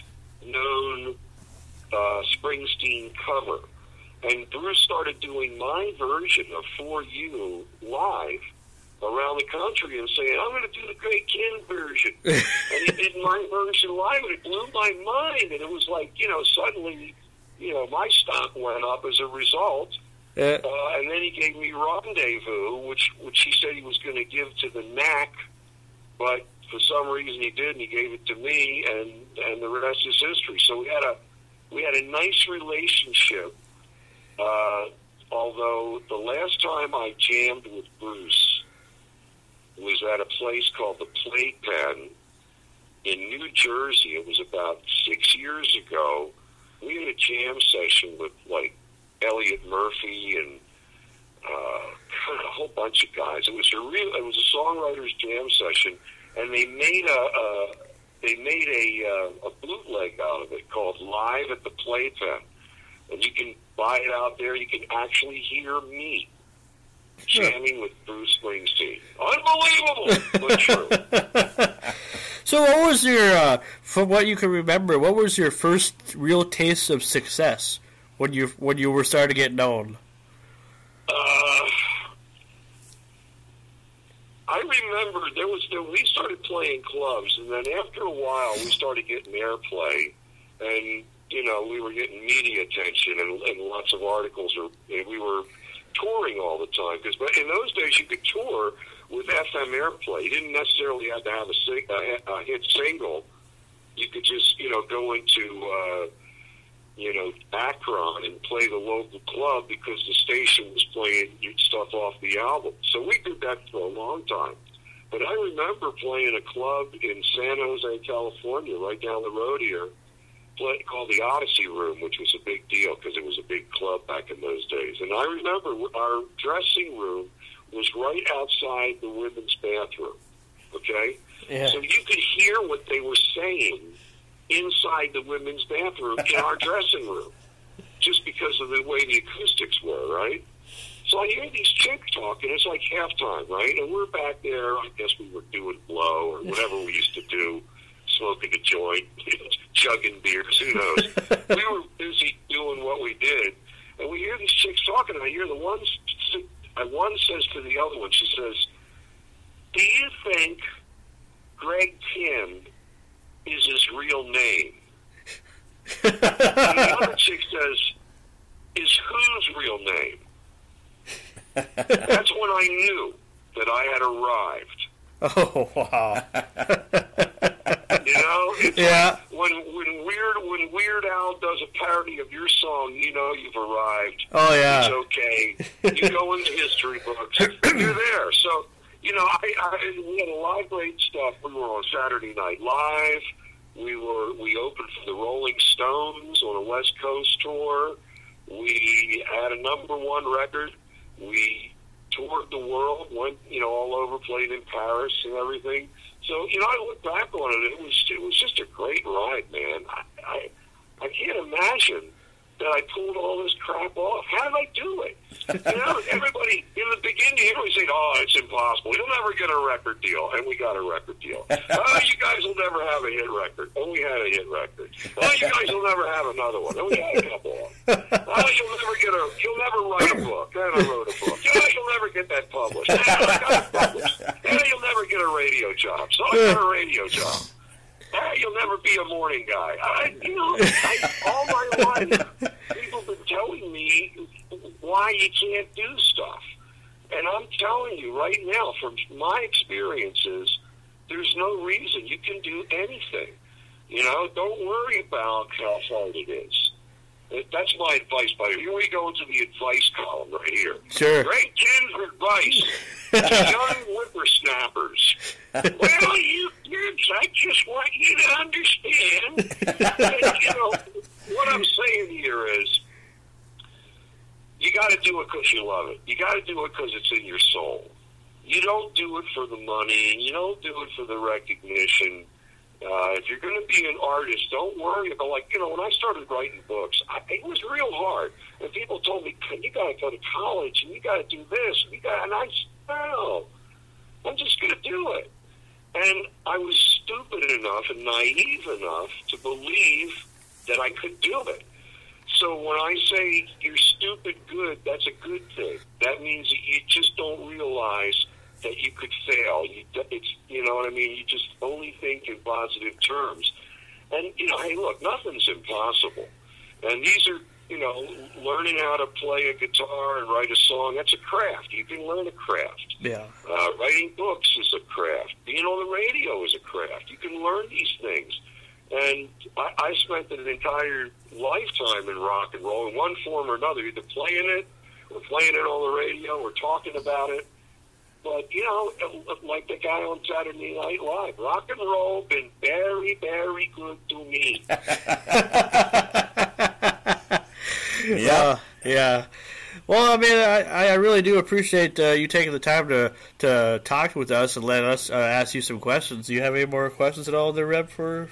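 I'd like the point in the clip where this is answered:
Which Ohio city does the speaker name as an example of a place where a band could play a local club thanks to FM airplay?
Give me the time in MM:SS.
01:47.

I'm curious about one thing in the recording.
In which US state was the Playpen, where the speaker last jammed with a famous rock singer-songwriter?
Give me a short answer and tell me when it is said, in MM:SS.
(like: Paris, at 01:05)
New Jersey, at 00:43.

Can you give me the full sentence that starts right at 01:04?
You can actually hear me jamming with Bruce Springsteen.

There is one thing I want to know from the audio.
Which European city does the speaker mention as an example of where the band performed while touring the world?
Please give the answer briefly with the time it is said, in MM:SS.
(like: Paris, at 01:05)
Paris, at 03:24.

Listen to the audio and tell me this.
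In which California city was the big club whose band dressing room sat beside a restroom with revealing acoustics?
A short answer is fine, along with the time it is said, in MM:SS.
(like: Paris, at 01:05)
San Jose, at 01:57.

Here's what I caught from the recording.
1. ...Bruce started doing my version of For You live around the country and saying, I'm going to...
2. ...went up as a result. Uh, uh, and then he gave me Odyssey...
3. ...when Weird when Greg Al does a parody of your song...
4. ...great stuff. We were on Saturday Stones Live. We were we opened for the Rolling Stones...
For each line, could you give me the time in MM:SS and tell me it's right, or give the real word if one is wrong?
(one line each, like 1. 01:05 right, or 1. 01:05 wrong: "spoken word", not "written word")
1. 00:04 right
2. 00:18 wrong: "Rendezvous", not "Odyssey"
3. 02:59 wrong: "Weird", not "Greg"
4. 03:10 wrong: "Night", not "Stones".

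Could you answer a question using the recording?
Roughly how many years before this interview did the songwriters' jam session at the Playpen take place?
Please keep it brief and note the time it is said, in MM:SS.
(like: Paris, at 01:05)
6, at 00:45.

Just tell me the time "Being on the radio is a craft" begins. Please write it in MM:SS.
05:25.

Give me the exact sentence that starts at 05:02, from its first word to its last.
So when I say you're stupid good, that's a good thing.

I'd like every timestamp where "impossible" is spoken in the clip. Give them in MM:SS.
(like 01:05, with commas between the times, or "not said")
03:38, 05:15.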